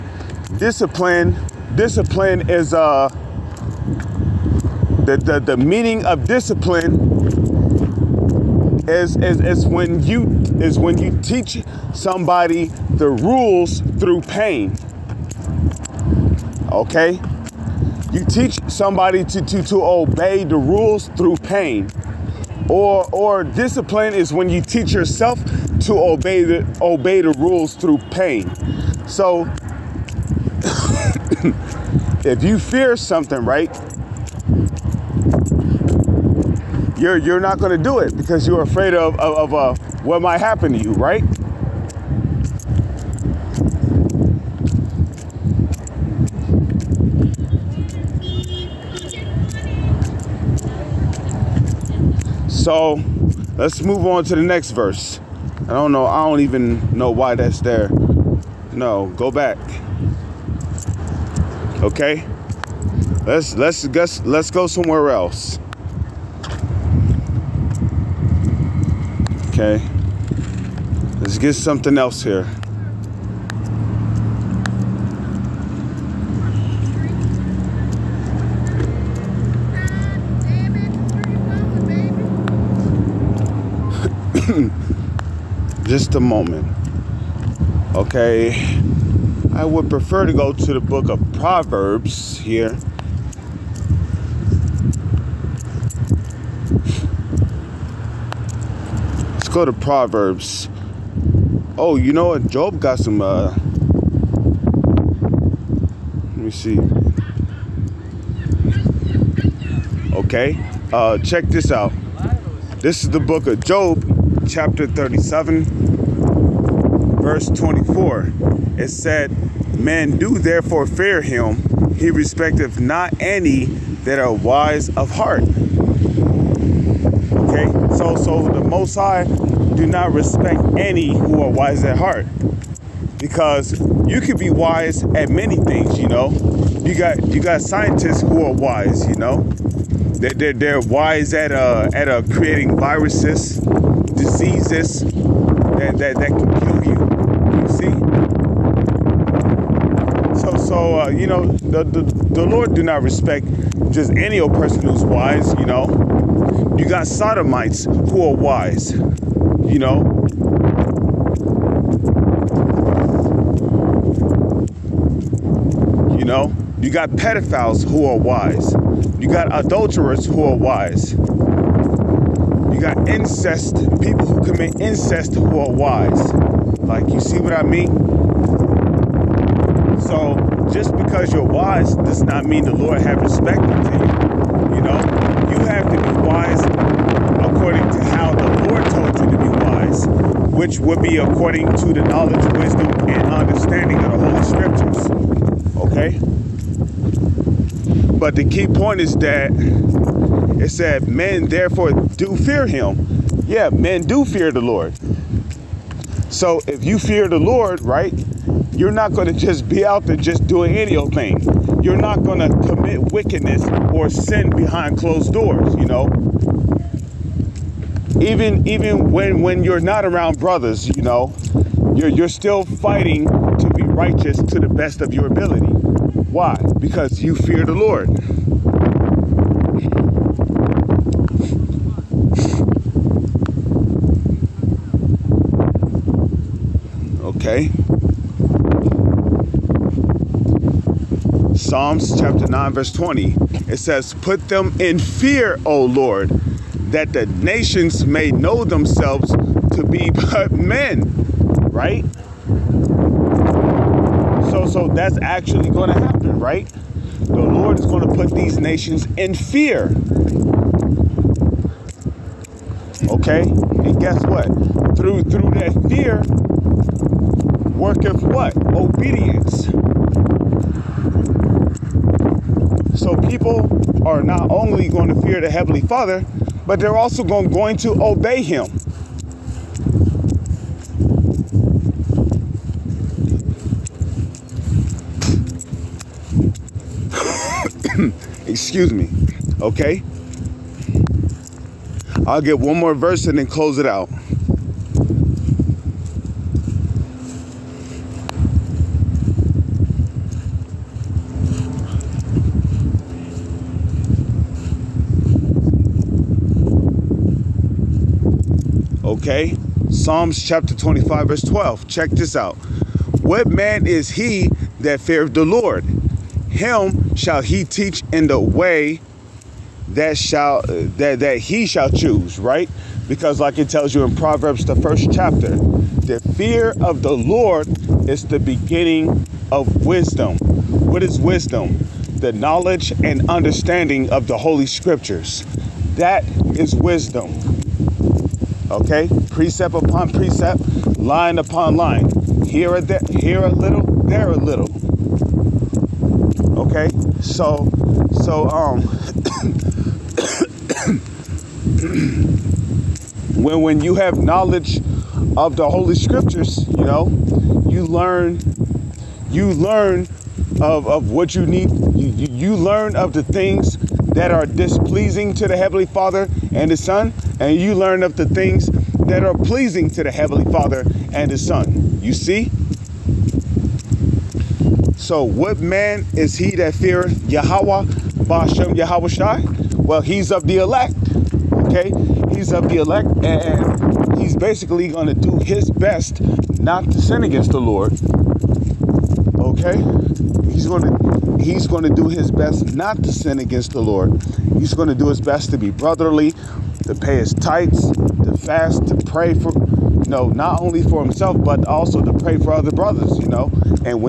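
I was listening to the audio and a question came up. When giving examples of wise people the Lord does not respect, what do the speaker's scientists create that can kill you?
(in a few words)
Viruses.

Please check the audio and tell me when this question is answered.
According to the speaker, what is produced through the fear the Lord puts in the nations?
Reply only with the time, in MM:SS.
04:28.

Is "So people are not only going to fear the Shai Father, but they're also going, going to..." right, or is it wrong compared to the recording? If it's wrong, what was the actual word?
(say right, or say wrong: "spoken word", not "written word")
wrong: "Heavenly", not "Shai".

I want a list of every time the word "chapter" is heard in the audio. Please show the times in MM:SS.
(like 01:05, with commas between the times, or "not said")
01:54, 04:02, 05:10, 05:25.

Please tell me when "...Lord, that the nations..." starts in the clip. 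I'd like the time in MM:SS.
04:05.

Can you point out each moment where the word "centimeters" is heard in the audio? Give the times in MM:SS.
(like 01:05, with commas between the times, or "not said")
not said.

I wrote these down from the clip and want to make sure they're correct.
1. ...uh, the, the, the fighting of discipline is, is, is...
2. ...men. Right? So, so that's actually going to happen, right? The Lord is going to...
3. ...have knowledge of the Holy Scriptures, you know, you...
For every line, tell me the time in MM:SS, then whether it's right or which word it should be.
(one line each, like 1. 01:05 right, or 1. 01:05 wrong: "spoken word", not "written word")
1. 00:02 wrong: "meaning", not "fighting"
2. 04:10 right
3. 05:53 right.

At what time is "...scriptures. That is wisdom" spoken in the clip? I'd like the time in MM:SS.
05:34.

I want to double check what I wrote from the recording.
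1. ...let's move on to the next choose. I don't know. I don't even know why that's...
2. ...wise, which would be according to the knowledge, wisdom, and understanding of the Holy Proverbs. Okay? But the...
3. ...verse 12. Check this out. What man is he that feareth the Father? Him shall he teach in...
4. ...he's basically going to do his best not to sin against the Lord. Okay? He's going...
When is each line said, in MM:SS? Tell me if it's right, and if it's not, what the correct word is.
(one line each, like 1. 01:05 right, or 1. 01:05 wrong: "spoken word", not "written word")
1. 00:53 wrong: "verse", not "choose"
2. 03:09 wrong: "Scriptures", not "Proverbs"
3. 05:11 wrong: "Lord", not "Father"
4. 06:24 right.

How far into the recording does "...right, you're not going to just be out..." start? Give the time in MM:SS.
03:27.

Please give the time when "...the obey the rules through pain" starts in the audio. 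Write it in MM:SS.
00:26.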